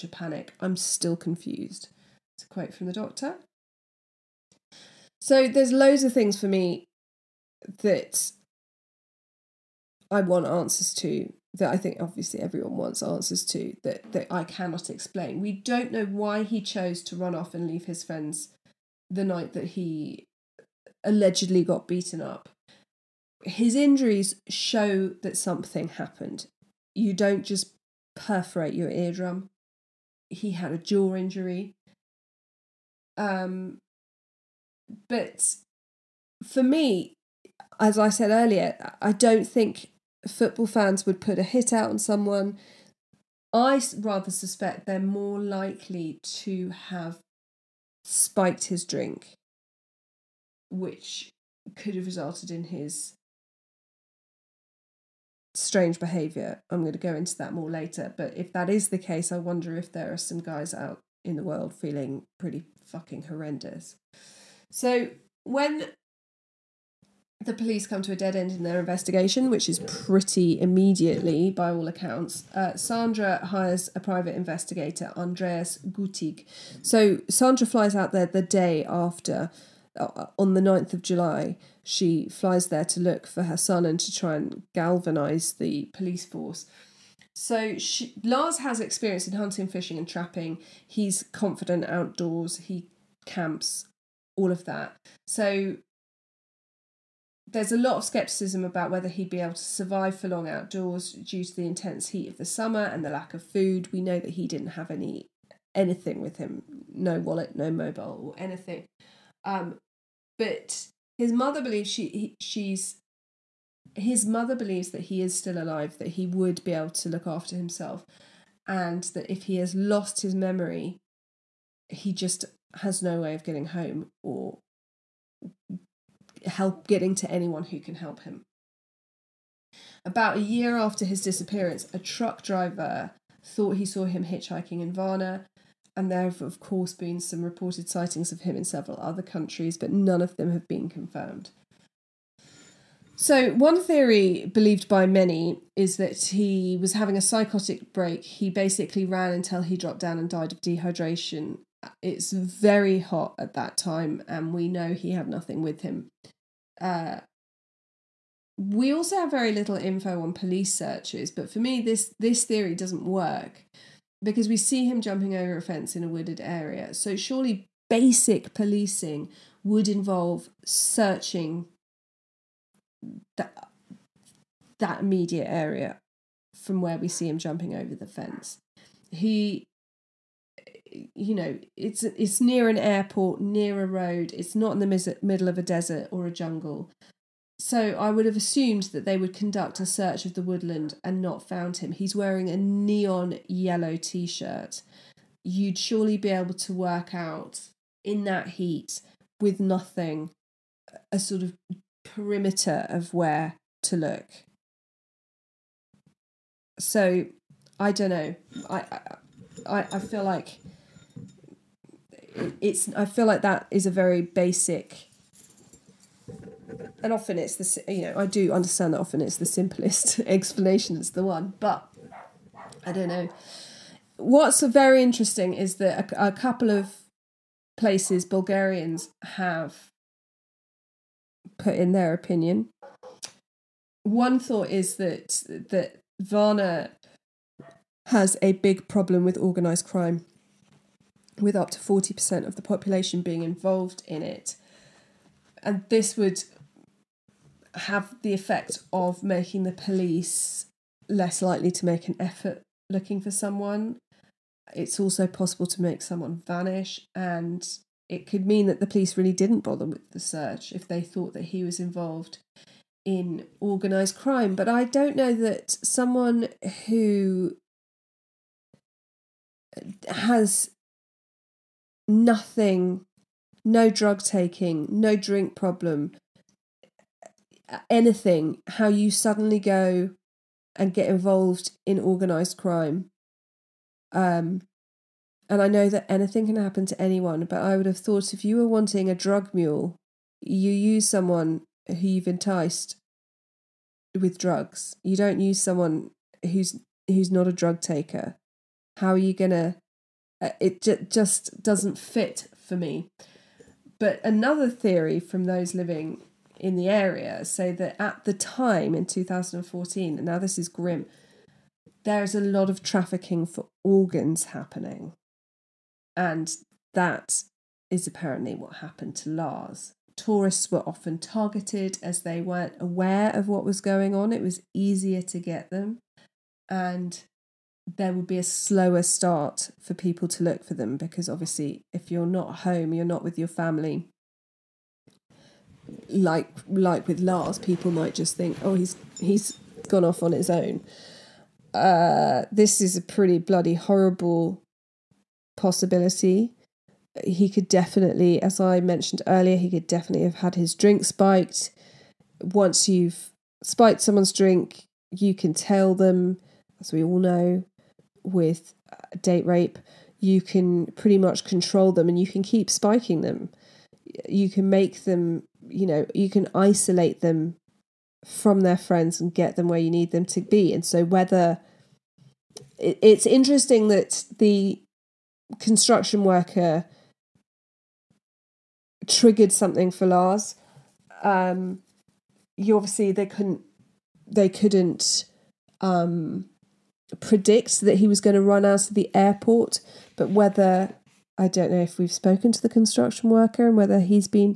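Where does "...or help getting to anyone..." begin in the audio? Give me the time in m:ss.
2:04.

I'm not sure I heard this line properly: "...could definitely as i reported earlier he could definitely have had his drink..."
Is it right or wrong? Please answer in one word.
wrong.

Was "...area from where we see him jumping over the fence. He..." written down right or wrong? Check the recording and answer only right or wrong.
right.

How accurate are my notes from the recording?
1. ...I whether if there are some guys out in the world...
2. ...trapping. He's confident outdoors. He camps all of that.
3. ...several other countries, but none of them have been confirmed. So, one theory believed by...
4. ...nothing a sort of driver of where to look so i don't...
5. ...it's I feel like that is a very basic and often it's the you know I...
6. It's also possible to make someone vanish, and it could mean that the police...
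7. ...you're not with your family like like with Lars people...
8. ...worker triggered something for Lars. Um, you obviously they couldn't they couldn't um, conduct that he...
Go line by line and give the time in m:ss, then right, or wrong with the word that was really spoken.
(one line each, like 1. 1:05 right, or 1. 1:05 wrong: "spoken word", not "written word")
1. 0:59 wrong: "wonder", not "whether"
2. 1:30 right
3. 2:18 right
4. 3:19 wrong: "perimeter", not "driver"
5. 3:32 right
6. 4:14 right
7. 5:32 right
8. 6:16 wrong: "predict", not "conduct".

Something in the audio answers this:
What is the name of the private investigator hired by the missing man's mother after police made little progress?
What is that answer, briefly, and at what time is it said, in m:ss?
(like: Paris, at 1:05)
Andreas Gutig, at 1:15.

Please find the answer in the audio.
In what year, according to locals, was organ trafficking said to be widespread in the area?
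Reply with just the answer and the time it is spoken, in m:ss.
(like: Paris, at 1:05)
2014, at 5:09.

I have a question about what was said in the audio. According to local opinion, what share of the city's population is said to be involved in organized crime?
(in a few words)
40%.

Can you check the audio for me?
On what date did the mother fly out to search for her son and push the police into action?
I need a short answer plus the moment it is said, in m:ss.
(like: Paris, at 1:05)
9th of July, at 1:20.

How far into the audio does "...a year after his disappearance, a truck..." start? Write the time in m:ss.
2:10.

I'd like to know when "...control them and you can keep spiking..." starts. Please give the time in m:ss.
6:01.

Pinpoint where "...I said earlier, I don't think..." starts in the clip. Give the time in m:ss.
0:37.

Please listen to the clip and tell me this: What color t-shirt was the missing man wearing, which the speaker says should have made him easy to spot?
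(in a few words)
Neon yellow.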